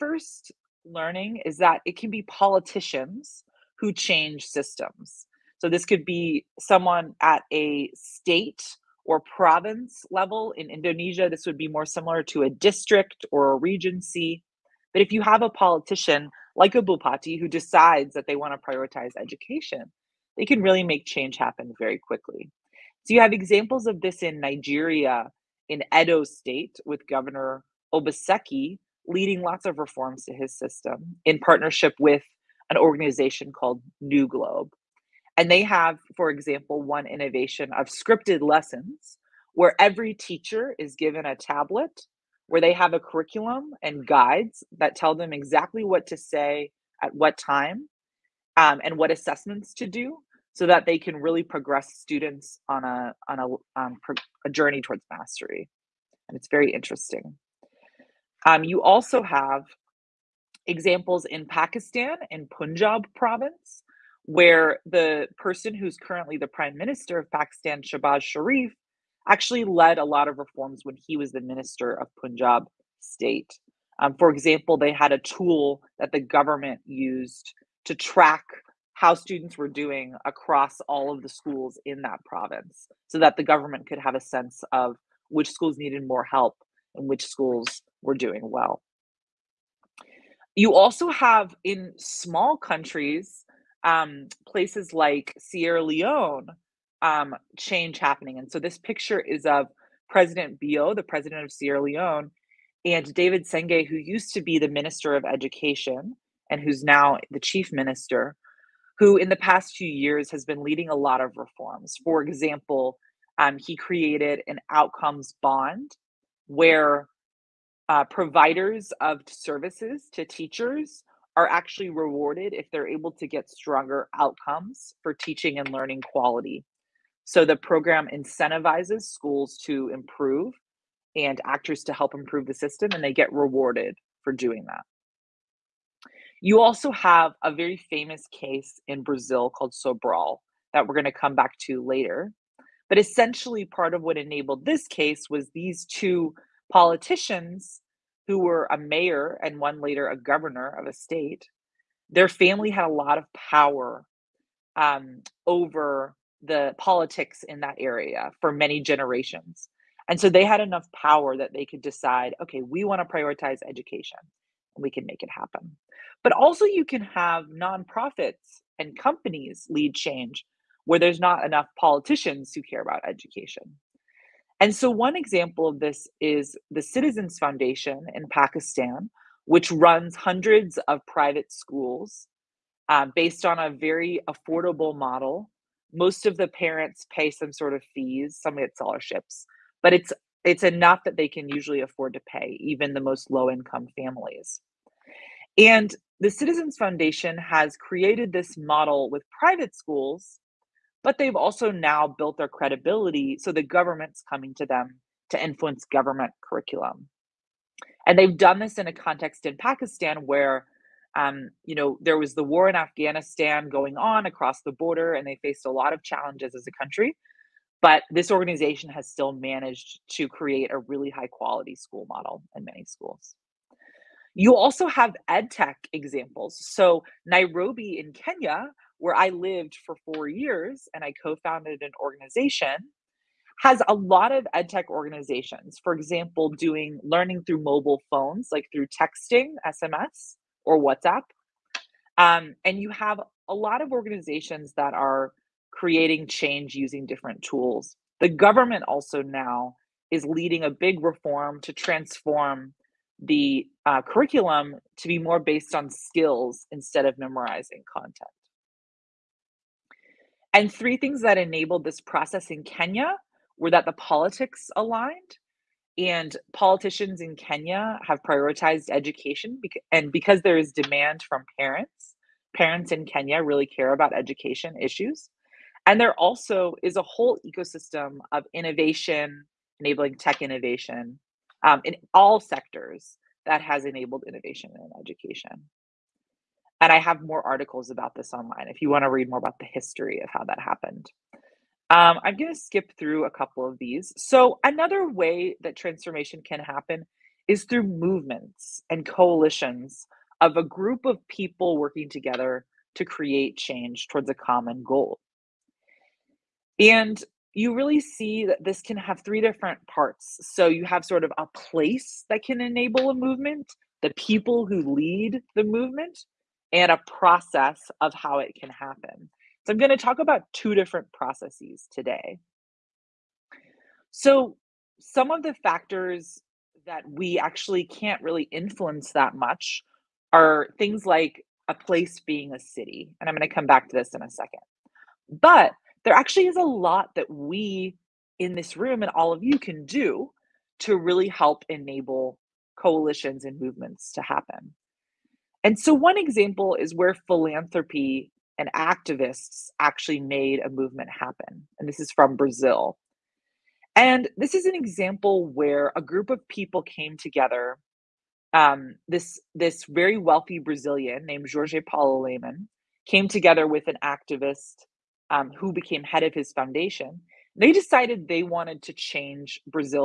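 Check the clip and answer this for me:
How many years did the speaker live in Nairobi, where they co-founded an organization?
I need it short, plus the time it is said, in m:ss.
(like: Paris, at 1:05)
4, at 3:50.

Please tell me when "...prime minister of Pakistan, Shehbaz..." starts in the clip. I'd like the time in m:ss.
1:06.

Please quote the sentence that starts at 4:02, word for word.
Um, and you have a lot of organizations that are creating change using different tools.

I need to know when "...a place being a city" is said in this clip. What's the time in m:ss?
5:31.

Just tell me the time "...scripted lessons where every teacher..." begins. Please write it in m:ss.
0:37.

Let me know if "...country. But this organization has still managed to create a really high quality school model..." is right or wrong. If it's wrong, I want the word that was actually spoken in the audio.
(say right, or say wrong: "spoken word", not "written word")
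right.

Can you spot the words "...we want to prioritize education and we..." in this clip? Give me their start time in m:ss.
2:42.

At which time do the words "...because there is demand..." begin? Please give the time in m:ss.
4:30.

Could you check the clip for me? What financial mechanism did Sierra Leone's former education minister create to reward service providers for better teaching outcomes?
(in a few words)
An outcomes bond.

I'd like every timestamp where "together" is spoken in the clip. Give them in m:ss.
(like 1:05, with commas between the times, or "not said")
5:02, 5:57, 6:03.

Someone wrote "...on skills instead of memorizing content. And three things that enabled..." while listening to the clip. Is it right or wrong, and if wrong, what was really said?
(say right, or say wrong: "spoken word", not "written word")
right.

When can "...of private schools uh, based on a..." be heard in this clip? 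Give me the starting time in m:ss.
3:00.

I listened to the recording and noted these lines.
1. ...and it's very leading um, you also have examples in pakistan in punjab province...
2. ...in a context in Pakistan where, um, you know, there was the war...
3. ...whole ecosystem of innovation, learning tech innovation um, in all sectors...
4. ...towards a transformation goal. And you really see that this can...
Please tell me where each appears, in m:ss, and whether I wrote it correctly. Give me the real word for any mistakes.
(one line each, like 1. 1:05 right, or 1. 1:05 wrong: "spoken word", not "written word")
1. 0:56 wrong: "interesting", not "leading"
2. 3:28 right
3. 4:37 wrong: "enabling", not "learning"
4. 5:04 wrong: "common", not "transformation".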